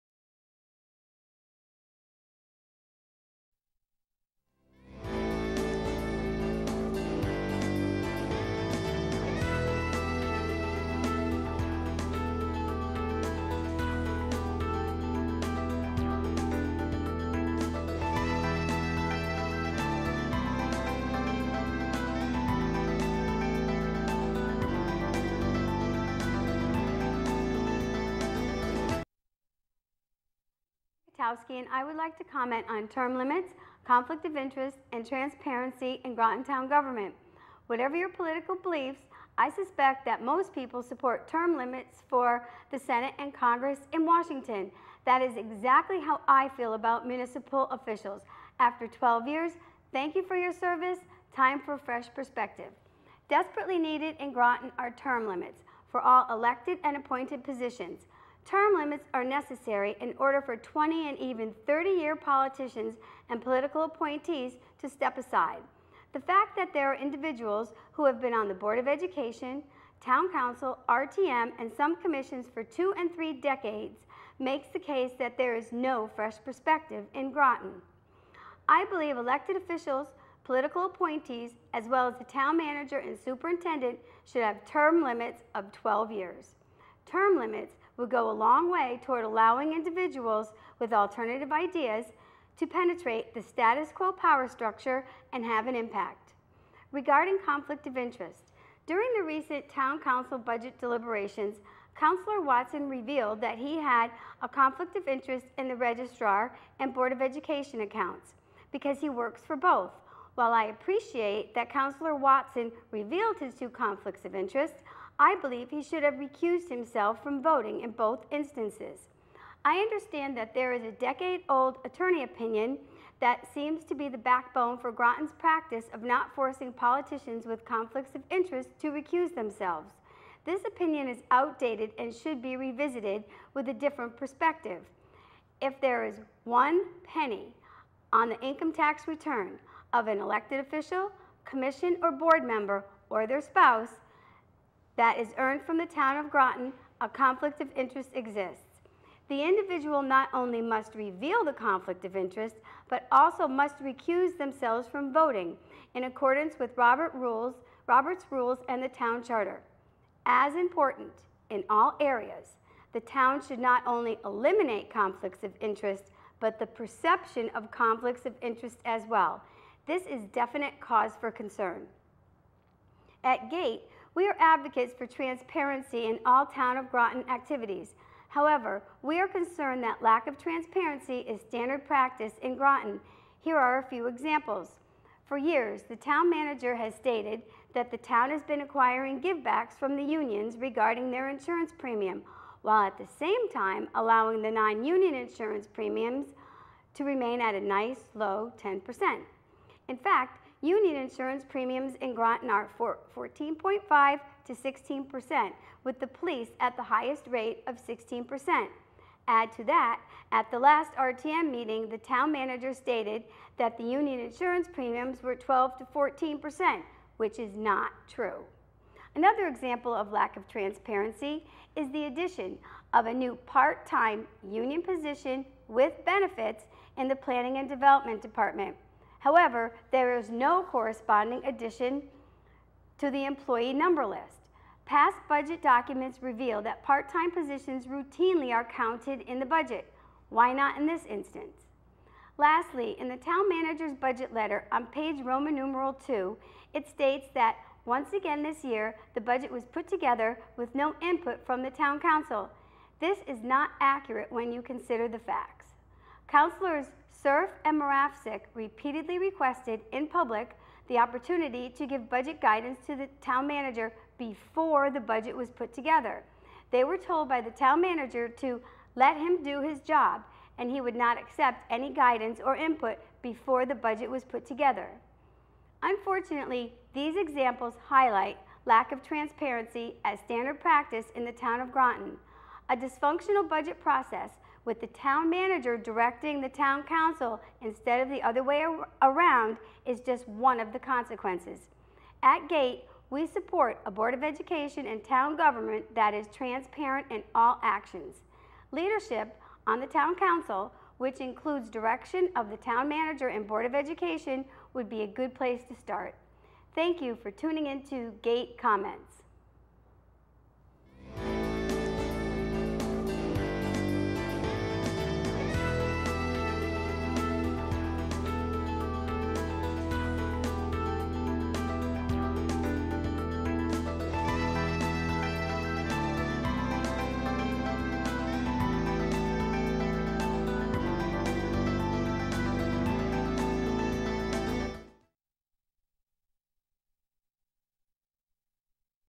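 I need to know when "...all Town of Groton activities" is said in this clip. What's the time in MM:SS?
02:56.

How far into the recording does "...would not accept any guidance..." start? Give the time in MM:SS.
04:30.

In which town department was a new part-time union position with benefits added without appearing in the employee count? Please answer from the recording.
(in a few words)
Planning and Development.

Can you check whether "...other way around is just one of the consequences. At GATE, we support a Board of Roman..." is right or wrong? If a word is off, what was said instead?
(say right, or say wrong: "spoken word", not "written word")
wrong: "Education", not "Roman".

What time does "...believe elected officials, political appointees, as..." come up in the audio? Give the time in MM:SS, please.
01:18.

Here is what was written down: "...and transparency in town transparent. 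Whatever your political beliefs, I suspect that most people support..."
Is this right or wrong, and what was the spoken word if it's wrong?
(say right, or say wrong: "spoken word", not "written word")
wrong: "government", not "transparent".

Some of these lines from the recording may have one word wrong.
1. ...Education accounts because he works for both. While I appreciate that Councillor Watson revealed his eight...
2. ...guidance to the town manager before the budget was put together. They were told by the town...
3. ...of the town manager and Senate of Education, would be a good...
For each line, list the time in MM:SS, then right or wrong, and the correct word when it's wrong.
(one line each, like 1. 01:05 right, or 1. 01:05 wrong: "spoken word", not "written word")
1. 01:47 wrong: "two", not "eight"
2. 04:22 right
3. 05:02 wrong: "Board", not "Senate".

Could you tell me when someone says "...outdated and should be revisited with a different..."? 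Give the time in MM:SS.
02:11.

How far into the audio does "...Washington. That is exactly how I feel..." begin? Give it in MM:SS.
00:44.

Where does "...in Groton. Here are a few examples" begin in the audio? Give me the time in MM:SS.
03:02.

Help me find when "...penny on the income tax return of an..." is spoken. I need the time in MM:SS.
02:17.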